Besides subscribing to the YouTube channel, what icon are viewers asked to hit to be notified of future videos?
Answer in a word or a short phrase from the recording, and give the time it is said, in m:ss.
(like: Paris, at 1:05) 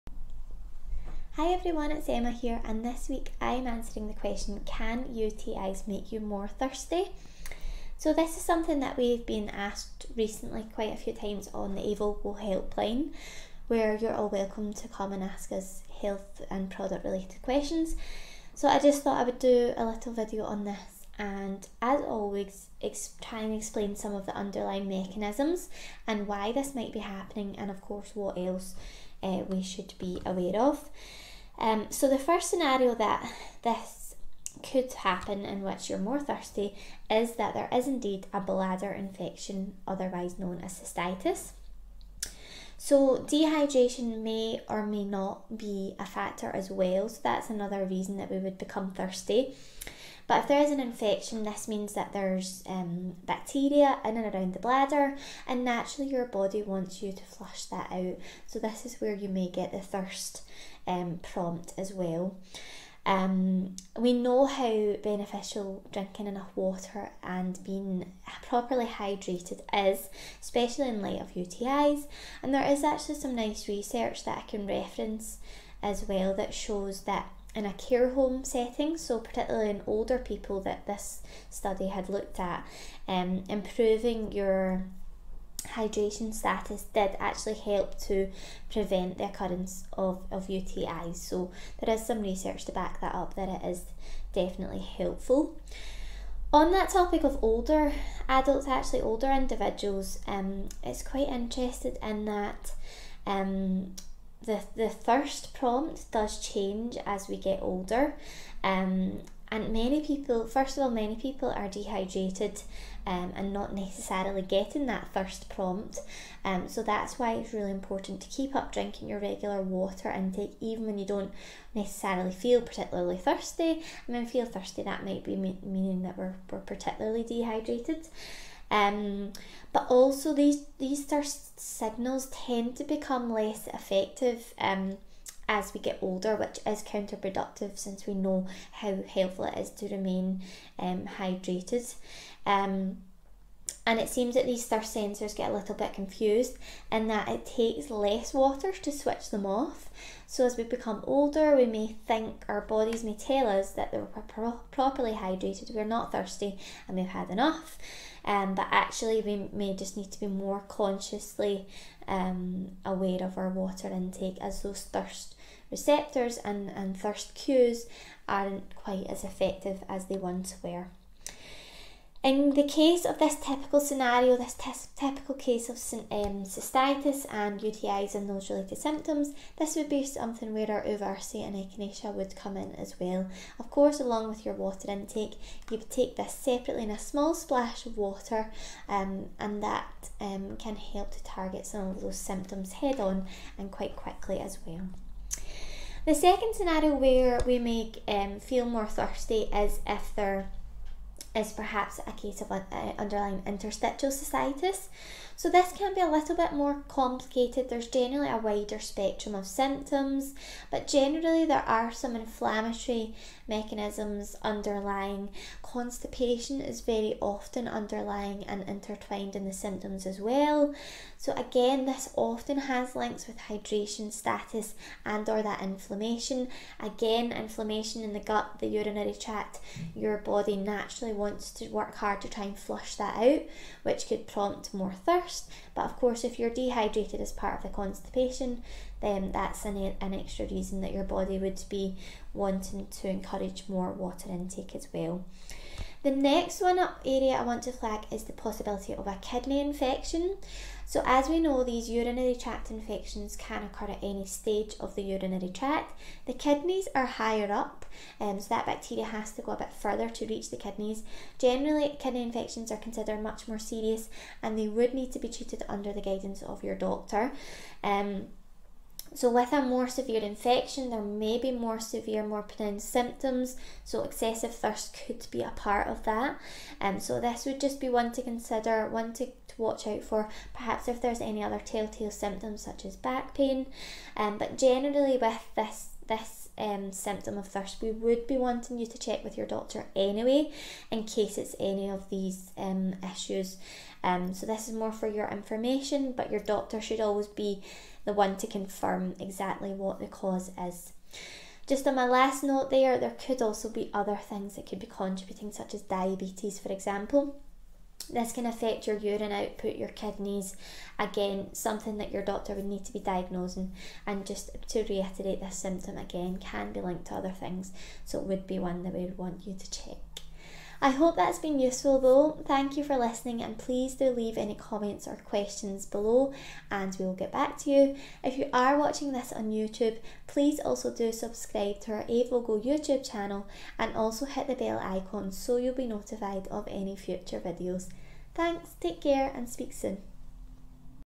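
bell icon, at 5:34.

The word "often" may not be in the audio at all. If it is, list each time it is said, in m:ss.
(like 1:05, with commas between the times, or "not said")
3:37, 3:42.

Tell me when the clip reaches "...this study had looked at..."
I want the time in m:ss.
1:20.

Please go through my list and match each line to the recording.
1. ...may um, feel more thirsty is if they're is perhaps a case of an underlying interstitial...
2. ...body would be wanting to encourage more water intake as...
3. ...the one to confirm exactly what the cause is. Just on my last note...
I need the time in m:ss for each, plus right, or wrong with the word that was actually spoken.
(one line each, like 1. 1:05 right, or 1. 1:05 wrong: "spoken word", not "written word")
1. 3:17 right
2. 4:01 right
3. 4:58 right.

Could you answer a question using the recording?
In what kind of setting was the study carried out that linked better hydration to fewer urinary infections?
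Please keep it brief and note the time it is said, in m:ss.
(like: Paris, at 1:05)
care home, at 1:17.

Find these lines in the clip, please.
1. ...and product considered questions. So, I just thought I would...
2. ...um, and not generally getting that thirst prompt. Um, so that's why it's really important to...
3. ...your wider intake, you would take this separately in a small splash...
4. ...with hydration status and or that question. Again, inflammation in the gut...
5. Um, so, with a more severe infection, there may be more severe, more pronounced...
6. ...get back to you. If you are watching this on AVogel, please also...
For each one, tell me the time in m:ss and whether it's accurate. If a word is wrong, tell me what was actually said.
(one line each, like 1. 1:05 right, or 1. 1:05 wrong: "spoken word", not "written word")
1. 0:16 wrong: "related", not "considered"
2. 1:53 wrong: "necessarily", not "generally"
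3. 3:04 wrong: "water", not "wider"
4. 3:43 wrong: "inflammation", not "question"
5. 4:27 right
6. 5:27 wrong: "YouTube", not "AVogel".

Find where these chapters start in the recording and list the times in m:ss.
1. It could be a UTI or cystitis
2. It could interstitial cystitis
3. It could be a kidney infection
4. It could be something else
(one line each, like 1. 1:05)
1. 0:33
2. 3:14
3. 4:05
4. 5:00.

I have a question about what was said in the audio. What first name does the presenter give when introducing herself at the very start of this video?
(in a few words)
Emma.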